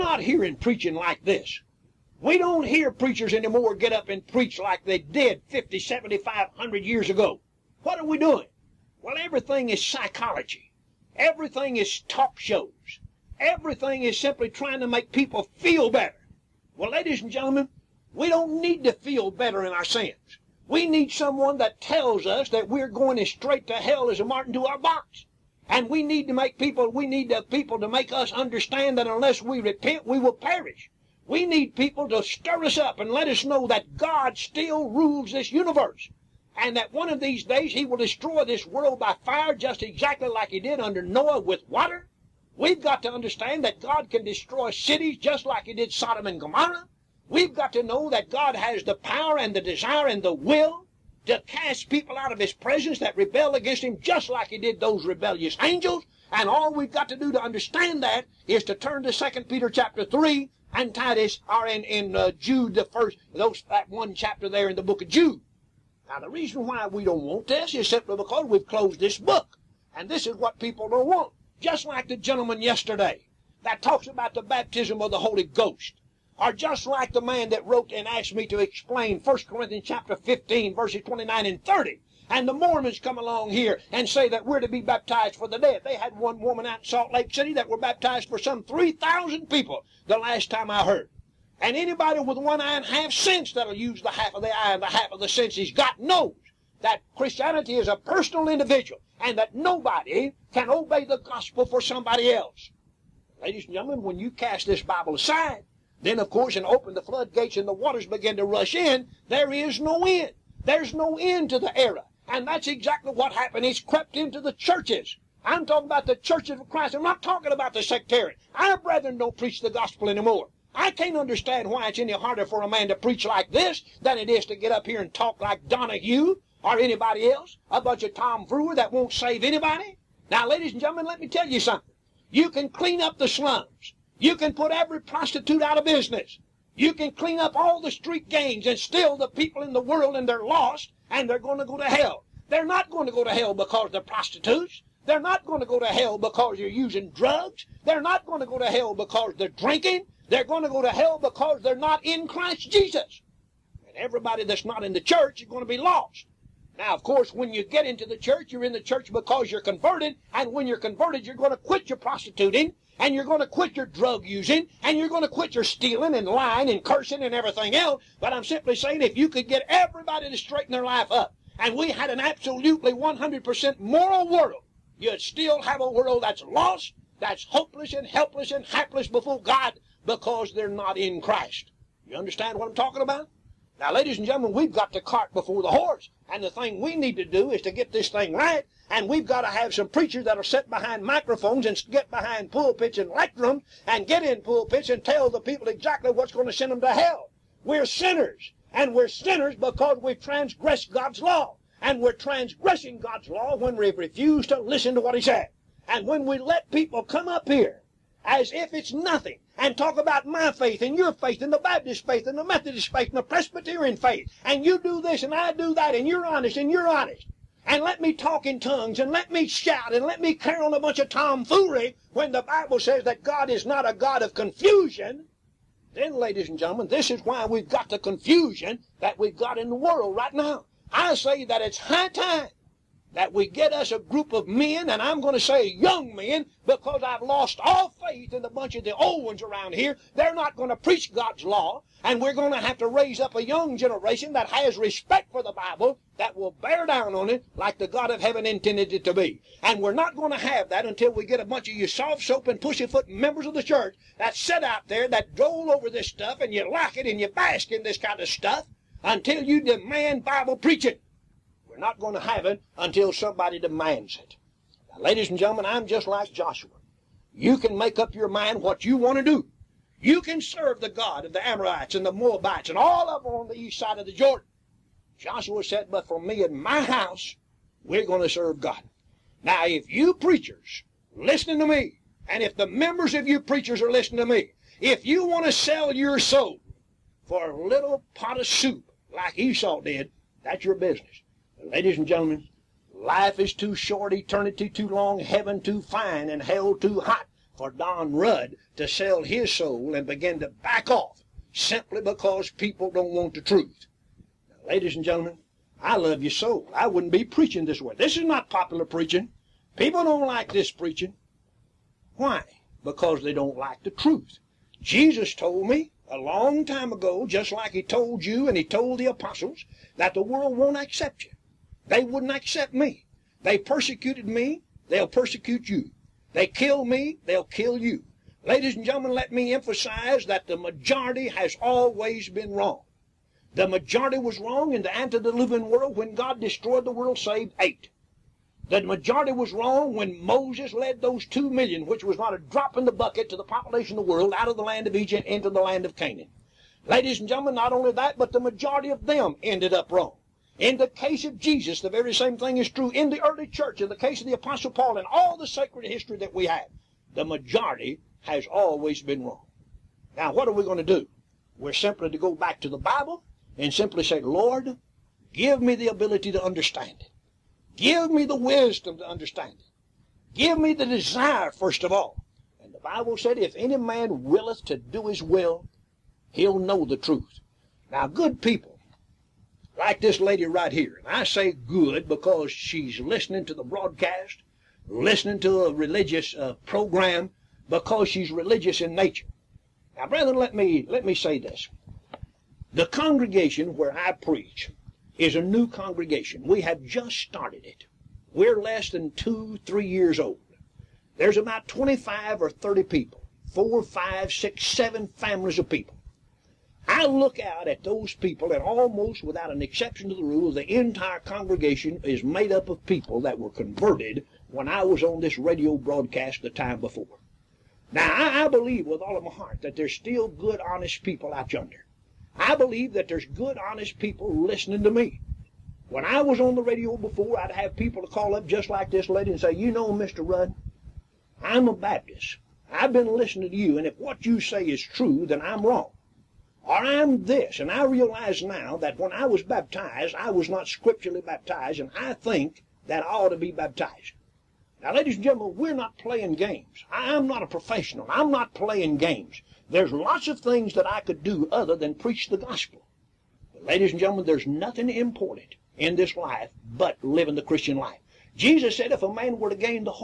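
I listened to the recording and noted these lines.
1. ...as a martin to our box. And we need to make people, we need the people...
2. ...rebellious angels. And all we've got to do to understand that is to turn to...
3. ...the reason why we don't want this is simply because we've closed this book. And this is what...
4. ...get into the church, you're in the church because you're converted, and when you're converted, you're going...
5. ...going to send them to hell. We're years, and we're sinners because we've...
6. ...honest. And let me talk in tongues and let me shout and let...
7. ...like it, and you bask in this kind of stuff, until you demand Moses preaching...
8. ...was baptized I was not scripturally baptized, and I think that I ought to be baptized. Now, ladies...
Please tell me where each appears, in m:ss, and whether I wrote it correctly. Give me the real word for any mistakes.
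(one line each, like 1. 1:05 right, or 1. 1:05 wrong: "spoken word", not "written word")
1. 0:24 right
2. 0:55 right
3. 1:06 right
4. 2:37 right
5. 3:16 wrong: "sinners", not "years"
6. 3:36 right
7. 4:16 wrong: "Bible", not "Moses"
8. 7:19 right.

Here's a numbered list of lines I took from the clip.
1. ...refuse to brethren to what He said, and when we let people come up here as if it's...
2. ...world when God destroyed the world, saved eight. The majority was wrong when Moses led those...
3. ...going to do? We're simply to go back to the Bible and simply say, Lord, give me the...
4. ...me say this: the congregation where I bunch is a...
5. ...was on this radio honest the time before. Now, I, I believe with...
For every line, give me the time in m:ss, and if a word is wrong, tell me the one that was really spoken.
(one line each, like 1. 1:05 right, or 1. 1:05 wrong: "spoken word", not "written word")
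1. 3:23 wrong: "listen", not "brethren"
2. 5:35 right
3. 6:00 right
4. 6:31 wrong: "preach", not "bunch"
5. 6:54 wrong: "broadcast", not "honest".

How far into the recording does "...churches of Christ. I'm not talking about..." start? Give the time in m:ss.
1:56.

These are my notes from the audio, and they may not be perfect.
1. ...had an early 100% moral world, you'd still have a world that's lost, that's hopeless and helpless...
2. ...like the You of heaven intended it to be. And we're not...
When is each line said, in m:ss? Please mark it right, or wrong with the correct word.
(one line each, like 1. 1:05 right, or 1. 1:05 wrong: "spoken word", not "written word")
1. 2:51 wrong: "absolutely", not "early"
2. 4:07 wrong: "God", not "You".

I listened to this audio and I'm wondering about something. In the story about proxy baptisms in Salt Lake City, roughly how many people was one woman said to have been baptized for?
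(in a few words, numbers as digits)
3,000.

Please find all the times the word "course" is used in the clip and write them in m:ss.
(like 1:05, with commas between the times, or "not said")
1:46, 2:37.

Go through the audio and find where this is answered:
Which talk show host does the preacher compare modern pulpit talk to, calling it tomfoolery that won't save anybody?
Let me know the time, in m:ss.
2:05.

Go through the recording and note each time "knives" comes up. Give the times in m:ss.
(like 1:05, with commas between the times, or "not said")
not said.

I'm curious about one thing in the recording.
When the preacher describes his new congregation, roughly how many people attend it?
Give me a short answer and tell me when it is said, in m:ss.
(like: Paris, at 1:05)
25 or 30, at 6:41.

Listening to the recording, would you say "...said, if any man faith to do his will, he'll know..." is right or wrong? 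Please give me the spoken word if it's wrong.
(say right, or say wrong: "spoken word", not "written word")
wrong: "willeth", not "faith".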